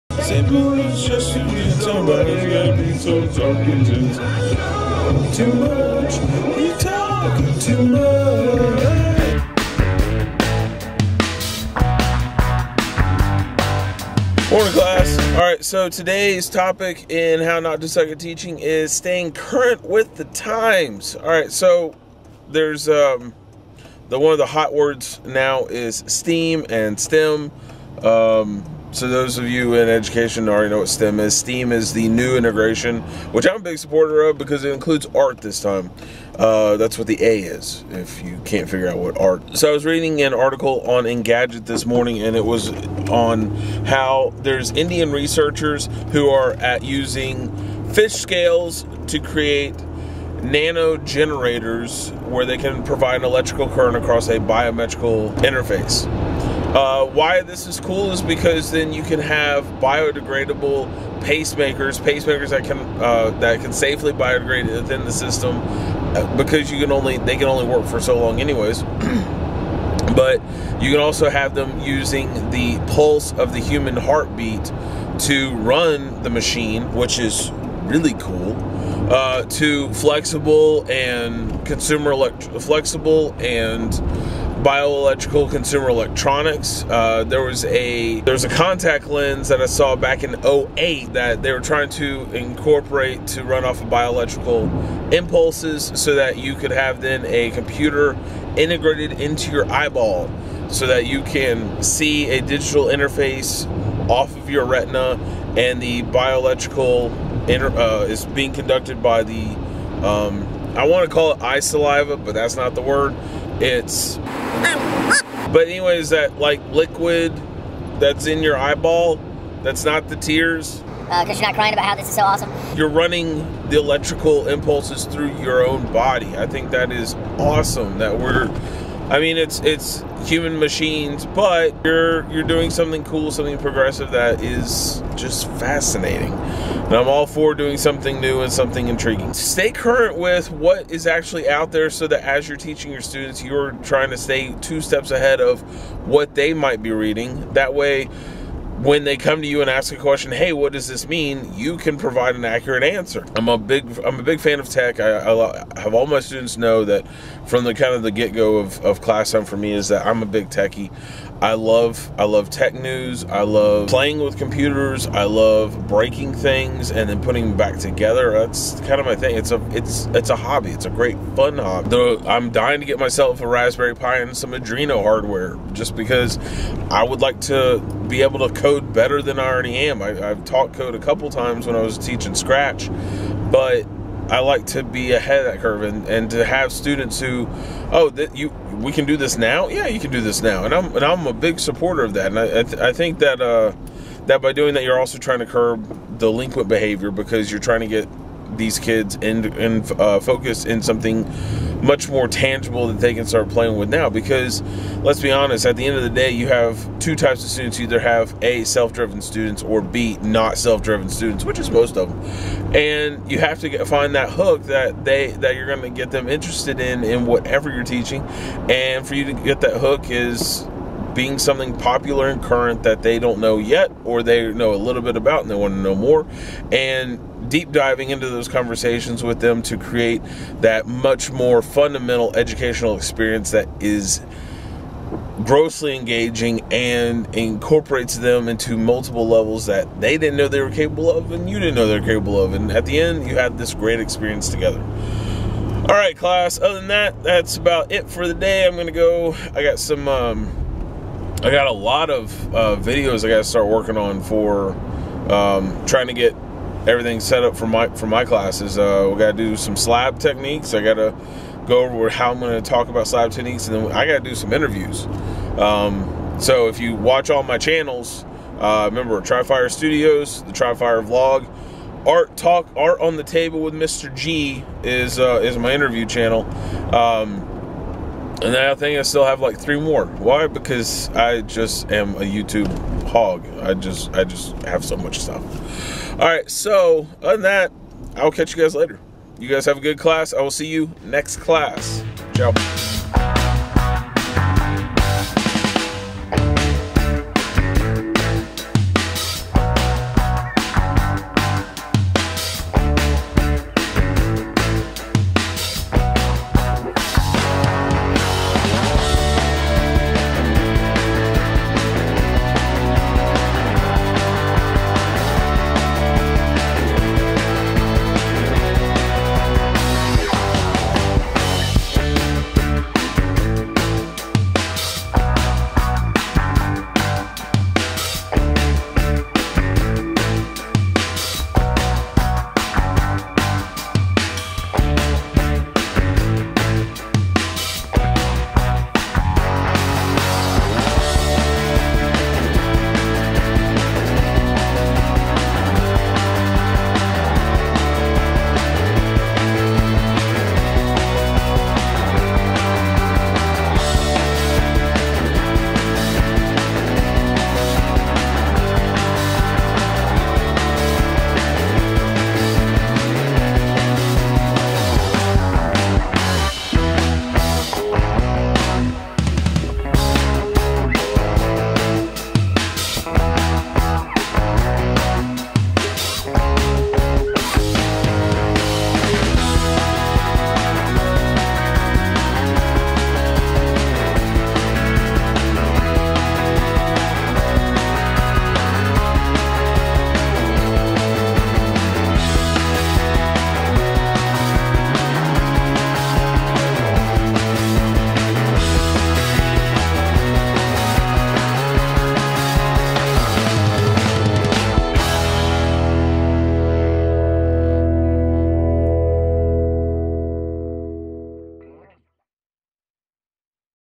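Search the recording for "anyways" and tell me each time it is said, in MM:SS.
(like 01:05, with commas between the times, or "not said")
01:08, 01:55.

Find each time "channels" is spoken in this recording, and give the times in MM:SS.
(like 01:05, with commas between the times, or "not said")
04:27, 04:36.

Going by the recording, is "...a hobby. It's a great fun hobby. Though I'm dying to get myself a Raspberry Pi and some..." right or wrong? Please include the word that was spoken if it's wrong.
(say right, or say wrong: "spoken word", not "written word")
right.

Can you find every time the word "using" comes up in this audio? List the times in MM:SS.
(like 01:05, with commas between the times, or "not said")
00:46, 01:11.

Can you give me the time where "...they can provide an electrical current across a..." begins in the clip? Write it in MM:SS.
00:52.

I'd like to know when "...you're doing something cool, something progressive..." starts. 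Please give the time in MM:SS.
02:12.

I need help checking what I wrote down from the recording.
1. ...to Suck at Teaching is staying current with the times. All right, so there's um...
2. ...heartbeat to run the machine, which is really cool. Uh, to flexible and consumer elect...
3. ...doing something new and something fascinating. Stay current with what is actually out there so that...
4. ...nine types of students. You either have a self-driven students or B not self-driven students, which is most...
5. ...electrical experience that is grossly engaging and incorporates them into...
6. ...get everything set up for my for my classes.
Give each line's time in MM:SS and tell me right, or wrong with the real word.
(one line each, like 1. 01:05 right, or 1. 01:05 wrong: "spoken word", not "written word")
1. 00:17 right
2. 01:13 right
3. 02:17 wrong: "intriguing", not "fascinating"
4. 03:26 wrong: "two", not "nine"
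5. 03:52 wrong: "educational", not "electrical"
6. 04:16 right.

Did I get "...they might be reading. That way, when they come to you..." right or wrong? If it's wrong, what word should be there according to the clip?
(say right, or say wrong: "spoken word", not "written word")
right.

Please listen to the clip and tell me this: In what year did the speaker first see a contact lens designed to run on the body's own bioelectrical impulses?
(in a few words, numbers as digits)
2008.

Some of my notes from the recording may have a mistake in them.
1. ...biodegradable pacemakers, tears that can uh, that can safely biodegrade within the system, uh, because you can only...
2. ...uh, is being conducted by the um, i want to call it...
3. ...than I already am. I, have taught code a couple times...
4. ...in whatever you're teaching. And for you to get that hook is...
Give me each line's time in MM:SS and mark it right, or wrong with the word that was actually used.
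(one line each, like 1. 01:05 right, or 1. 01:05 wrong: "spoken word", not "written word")
1. 00:59 wrong: "pacemakers", not "tears"
2. 01:47 right
3. 02:59 right
4. 03:37 right.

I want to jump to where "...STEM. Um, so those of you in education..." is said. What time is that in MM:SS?
00:26.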